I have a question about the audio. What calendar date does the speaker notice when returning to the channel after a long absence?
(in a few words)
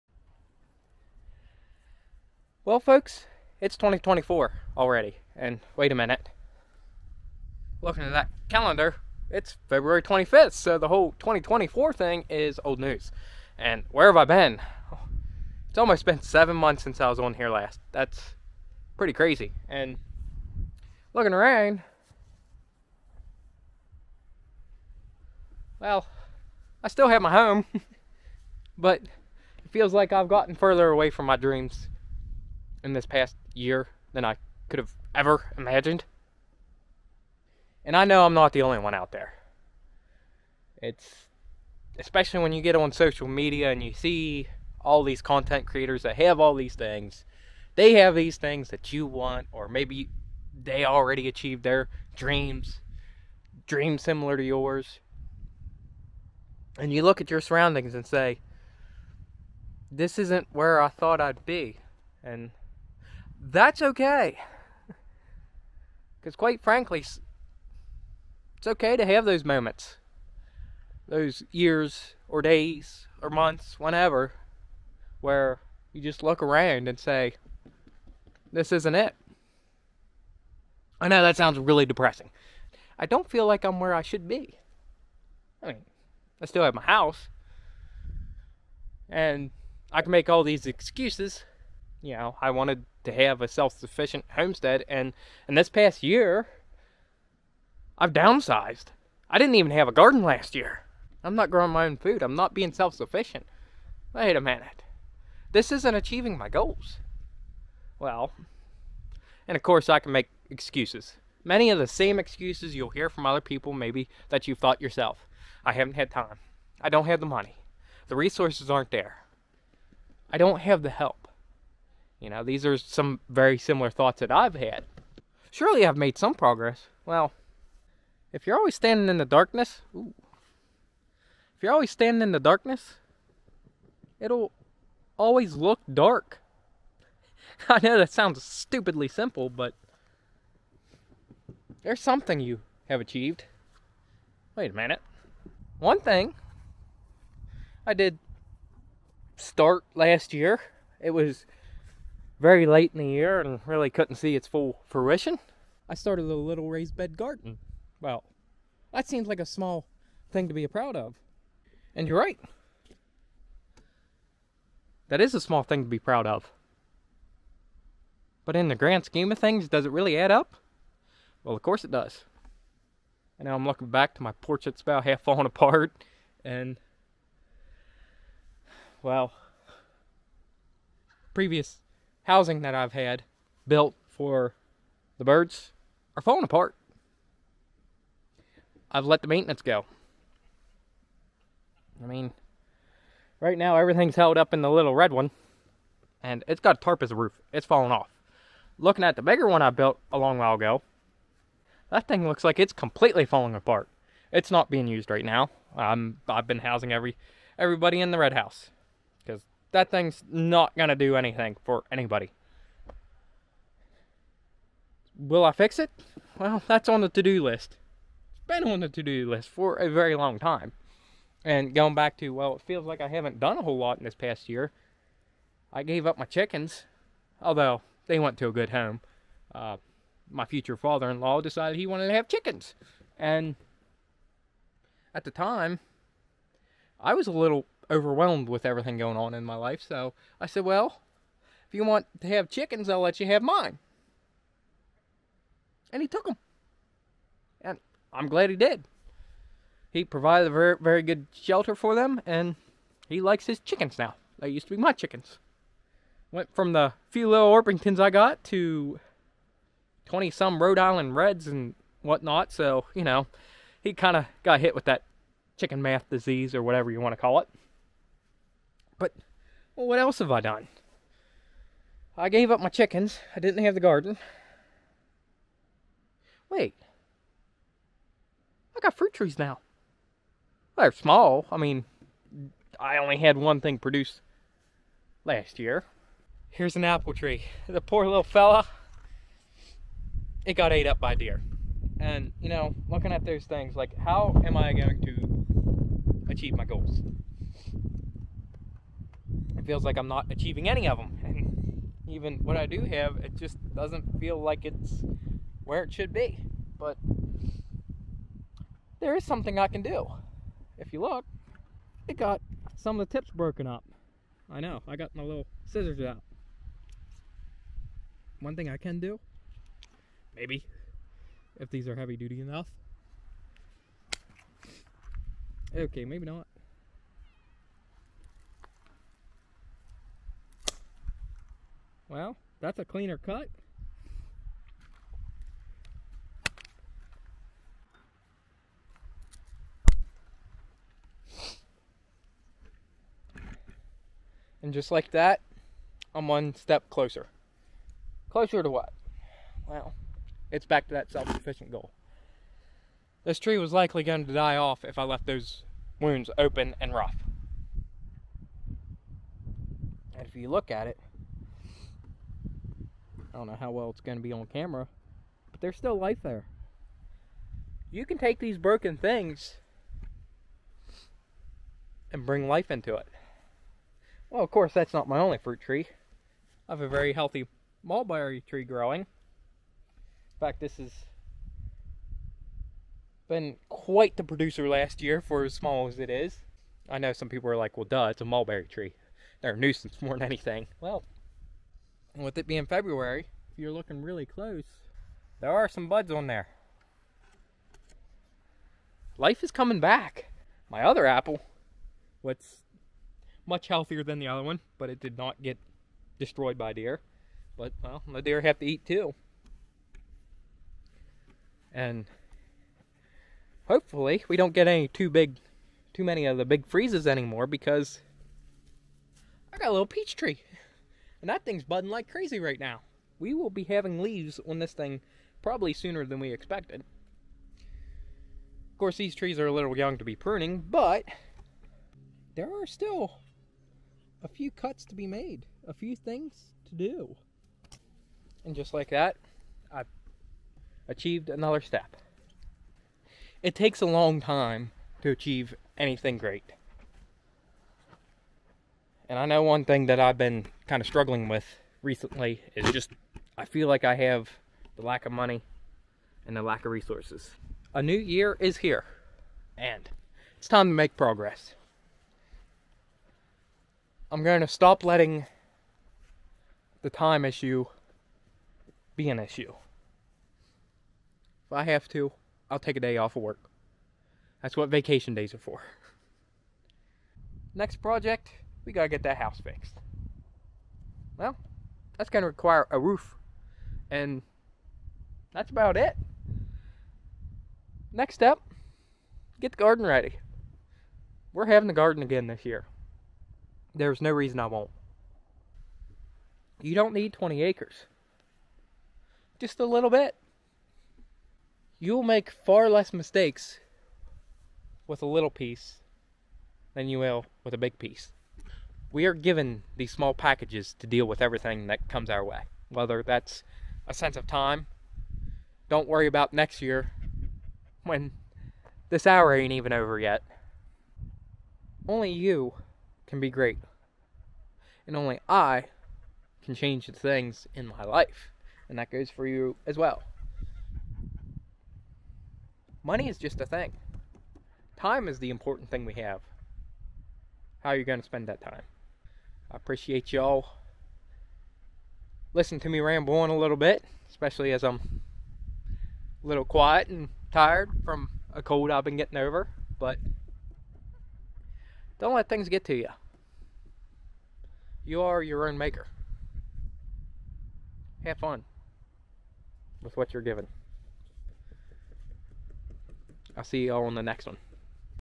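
February 25th.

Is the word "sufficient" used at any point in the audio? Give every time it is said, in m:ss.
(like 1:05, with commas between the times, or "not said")
1:33, 1:42, 5:51.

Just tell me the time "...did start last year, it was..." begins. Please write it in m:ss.
2:27.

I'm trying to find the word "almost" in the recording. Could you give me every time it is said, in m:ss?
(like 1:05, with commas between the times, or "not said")
0:15.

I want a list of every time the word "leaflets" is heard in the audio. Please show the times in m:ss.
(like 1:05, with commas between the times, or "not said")
not said.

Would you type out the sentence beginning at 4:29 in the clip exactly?
But well, what else have I done?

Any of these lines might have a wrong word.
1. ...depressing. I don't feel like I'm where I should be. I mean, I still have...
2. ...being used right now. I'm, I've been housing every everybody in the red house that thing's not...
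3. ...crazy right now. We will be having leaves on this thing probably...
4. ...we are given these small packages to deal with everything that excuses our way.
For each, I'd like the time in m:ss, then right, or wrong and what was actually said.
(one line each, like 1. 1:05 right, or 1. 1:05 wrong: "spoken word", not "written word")
1. 1:21 right
2. 3:24 right
3. 7:02 right
4. 8:28 wrong: "comes", not "excuses".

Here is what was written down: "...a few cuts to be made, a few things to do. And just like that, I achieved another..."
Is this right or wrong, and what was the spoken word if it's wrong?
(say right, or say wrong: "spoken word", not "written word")
right.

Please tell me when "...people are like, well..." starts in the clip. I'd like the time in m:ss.
6:27.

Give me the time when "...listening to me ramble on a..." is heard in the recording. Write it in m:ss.
9:02.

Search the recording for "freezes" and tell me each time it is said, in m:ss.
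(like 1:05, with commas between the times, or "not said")
6:56.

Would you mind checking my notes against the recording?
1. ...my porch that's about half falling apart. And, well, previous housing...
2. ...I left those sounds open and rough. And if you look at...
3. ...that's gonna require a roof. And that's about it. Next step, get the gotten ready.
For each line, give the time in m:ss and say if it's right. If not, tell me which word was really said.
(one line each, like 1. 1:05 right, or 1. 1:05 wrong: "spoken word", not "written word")
1. 2:54 right
2. 5:54 wrong: "wounds", not "sounds"
3. 8:01 wrong: "garden", not "gotten".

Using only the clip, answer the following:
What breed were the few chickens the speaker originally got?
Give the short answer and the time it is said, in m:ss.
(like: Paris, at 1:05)
Orpingtons, at 4:17.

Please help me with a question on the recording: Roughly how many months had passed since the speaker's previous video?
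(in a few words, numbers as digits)
7.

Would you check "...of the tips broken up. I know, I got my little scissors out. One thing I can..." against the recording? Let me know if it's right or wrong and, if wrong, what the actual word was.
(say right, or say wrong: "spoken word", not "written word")
right.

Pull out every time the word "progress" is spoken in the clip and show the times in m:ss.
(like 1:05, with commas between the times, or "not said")
2:06, 7:40.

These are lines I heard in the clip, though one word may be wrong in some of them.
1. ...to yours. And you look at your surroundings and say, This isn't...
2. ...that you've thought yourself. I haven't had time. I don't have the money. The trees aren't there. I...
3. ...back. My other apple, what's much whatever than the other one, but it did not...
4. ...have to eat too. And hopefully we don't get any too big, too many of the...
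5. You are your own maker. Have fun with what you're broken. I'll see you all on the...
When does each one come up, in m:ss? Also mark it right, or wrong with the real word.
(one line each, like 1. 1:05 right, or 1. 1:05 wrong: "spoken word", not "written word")
1. 0:54 right
2. 1:54 wrong: "resources", not "trees"
3. 6:39 wrong: "healthier", not "whatever"
4. 6:48 right
5. 9:14 wrong: "given", not "broken".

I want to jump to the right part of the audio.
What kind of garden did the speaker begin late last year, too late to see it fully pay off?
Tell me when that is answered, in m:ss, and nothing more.
2:36.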